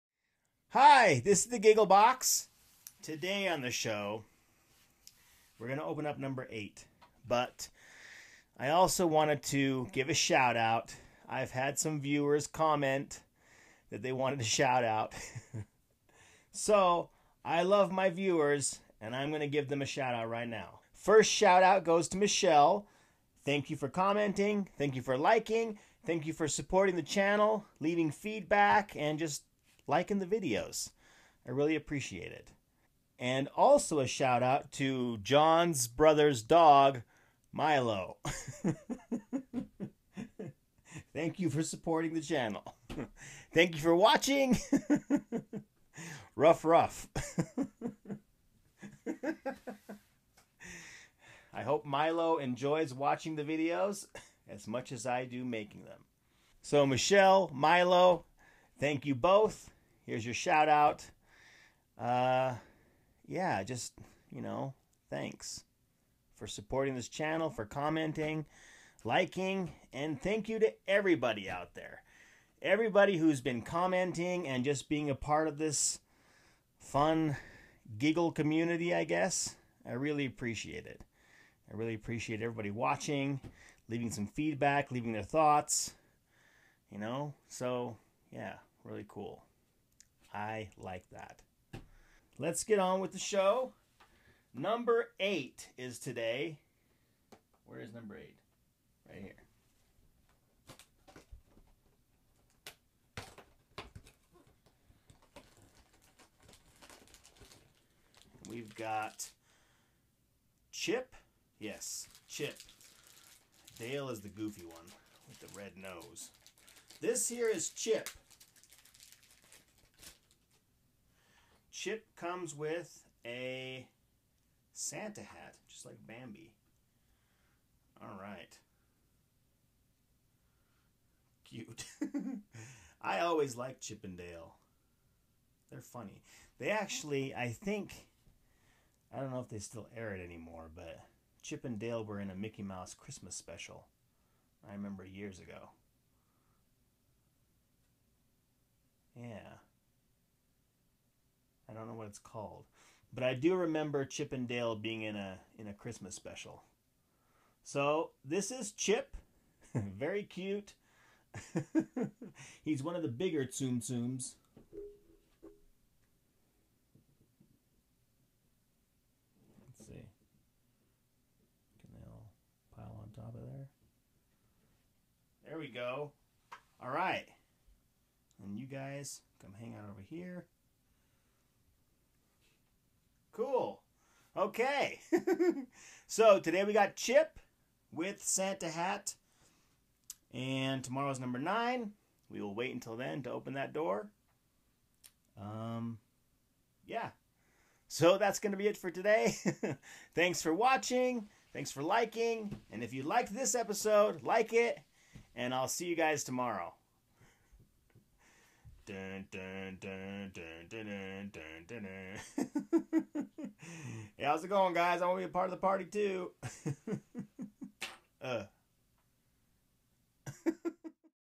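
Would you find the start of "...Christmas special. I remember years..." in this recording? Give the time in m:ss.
2:22.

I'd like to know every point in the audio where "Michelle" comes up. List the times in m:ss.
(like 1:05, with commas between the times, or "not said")
0:22, 0:56.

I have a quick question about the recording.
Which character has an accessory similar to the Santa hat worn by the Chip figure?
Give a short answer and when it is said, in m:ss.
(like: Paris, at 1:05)
Bambi, at 2:06.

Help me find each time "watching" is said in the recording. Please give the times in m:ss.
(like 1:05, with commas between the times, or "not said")
0:43, 0:52, 1:22, 3:20.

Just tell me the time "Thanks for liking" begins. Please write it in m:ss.
3:21.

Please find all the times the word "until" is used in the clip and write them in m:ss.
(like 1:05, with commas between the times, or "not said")
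3:12.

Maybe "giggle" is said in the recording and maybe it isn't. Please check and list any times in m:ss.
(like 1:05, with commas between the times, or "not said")
0:01, 1:17.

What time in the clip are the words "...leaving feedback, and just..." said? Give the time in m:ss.
0:27.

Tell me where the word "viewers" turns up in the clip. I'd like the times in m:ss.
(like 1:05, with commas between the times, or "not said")
0:11, 0:18.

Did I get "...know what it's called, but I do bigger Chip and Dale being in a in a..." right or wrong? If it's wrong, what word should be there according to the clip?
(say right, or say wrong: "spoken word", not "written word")
wrong: "remember", not "bigger".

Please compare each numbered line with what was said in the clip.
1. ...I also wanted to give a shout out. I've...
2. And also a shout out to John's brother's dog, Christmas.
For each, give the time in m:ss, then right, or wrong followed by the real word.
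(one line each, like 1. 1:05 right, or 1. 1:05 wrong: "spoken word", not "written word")
1. 0:08 right
2. 0:33 wrong: "Milo", not "Christmas".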